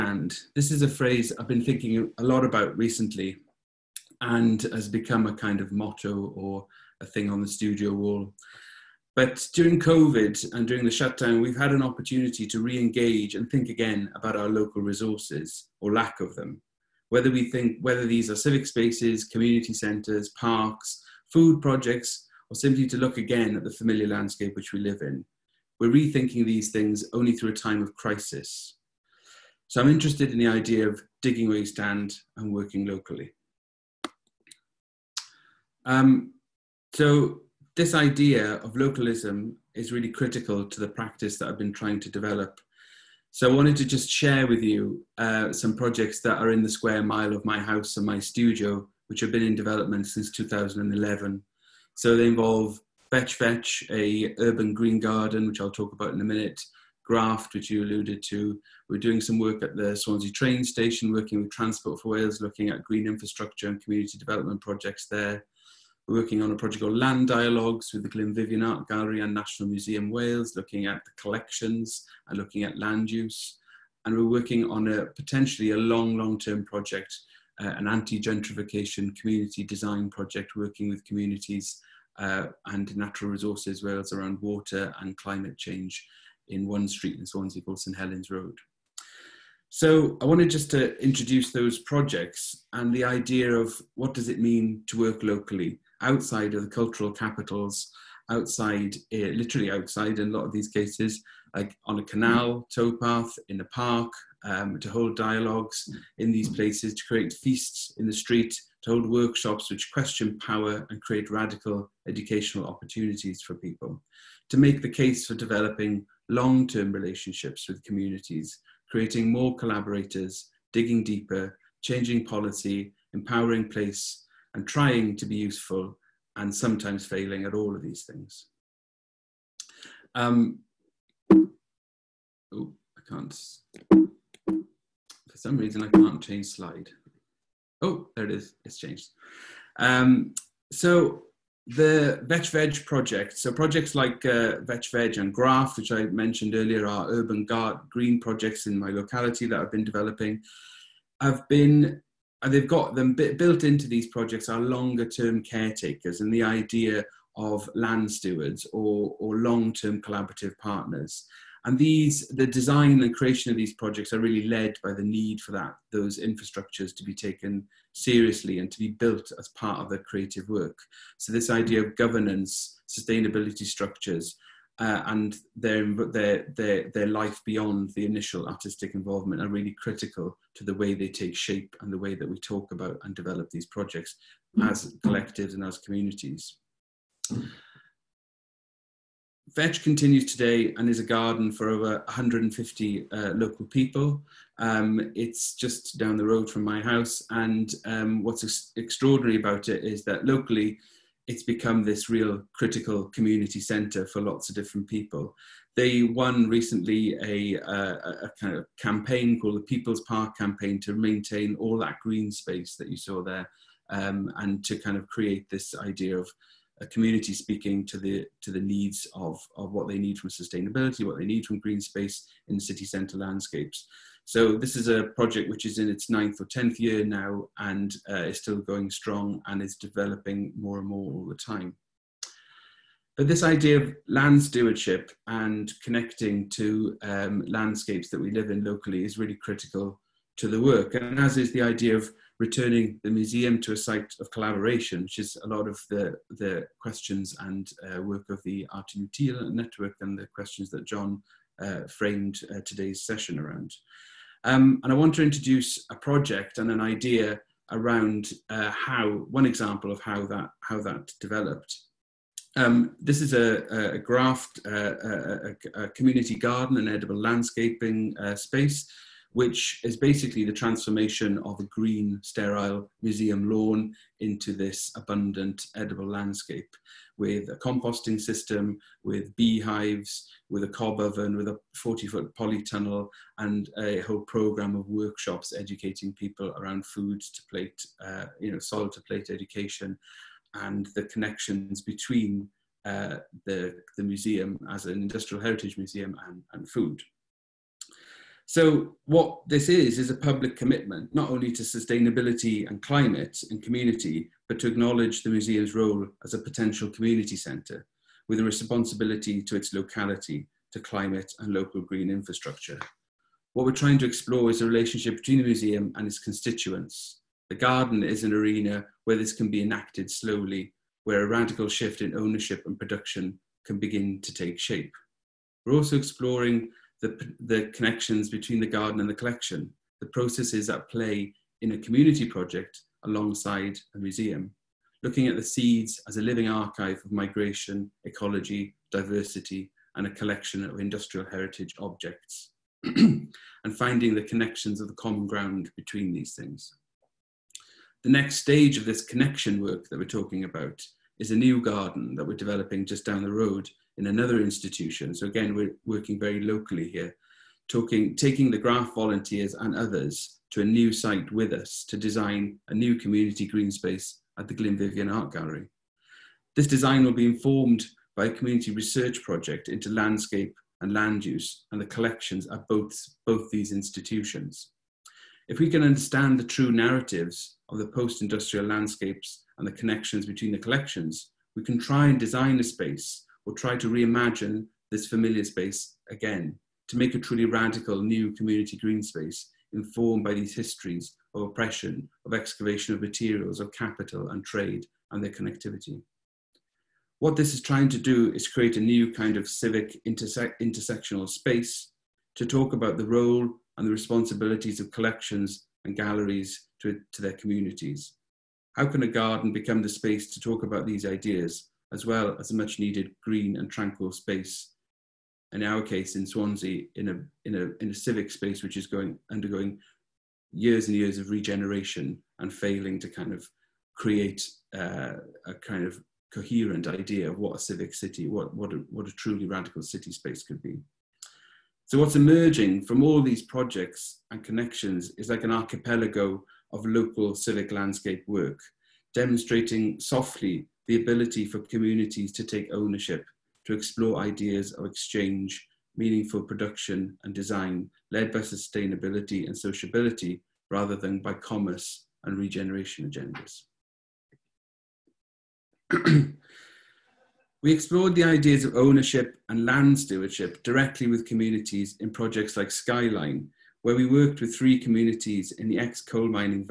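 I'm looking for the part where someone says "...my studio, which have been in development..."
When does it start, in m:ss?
0:48.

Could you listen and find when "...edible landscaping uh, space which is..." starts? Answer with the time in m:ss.
4:26.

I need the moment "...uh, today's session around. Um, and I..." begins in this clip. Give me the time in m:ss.
4:12.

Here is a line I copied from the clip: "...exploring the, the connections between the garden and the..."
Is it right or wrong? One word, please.
right.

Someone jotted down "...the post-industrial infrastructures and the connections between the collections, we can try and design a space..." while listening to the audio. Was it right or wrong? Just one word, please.
wrong.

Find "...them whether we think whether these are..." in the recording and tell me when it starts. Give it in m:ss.
0:16.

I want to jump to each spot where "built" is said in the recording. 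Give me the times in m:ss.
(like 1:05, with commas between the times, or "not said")
2:33, 2:48.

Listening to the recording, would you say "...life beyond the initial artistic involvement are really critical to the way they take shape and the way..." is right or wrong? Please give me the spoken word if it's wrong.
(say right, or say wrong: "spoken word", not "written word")
right.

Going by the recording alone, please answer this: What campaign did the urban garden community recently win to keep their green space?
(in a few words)
People's Park campaign.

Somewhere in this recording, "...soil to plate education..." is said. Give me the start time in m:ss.
4:48.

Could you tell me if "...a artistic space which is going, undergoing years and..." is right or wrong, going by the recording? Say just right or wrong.
wrong.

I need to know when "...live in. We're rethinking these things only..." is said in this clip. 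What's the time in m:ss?
0:24.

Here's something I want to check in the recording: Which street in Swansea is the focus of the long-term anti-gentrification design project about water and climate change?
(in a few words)
St Helens Road.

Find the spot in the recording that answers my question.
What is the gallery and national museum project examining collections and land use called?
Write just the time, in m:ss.
1:06.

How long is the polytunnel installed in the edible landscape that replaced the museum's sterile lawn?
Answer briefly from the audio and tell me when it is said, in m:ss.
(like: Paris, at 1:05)
40 foot, at 4:41.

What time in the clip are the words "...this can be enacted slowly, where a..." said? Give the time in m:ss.
5:19.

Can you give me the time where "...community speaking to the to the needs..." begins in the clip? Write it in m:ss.
3:36.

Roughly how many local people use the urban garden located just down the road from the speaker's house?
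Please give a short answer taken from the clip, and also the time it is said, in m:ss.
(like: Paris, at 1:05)
over 150, at 3:11.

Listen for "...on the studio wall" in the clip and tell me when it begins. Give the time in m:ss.
0:07.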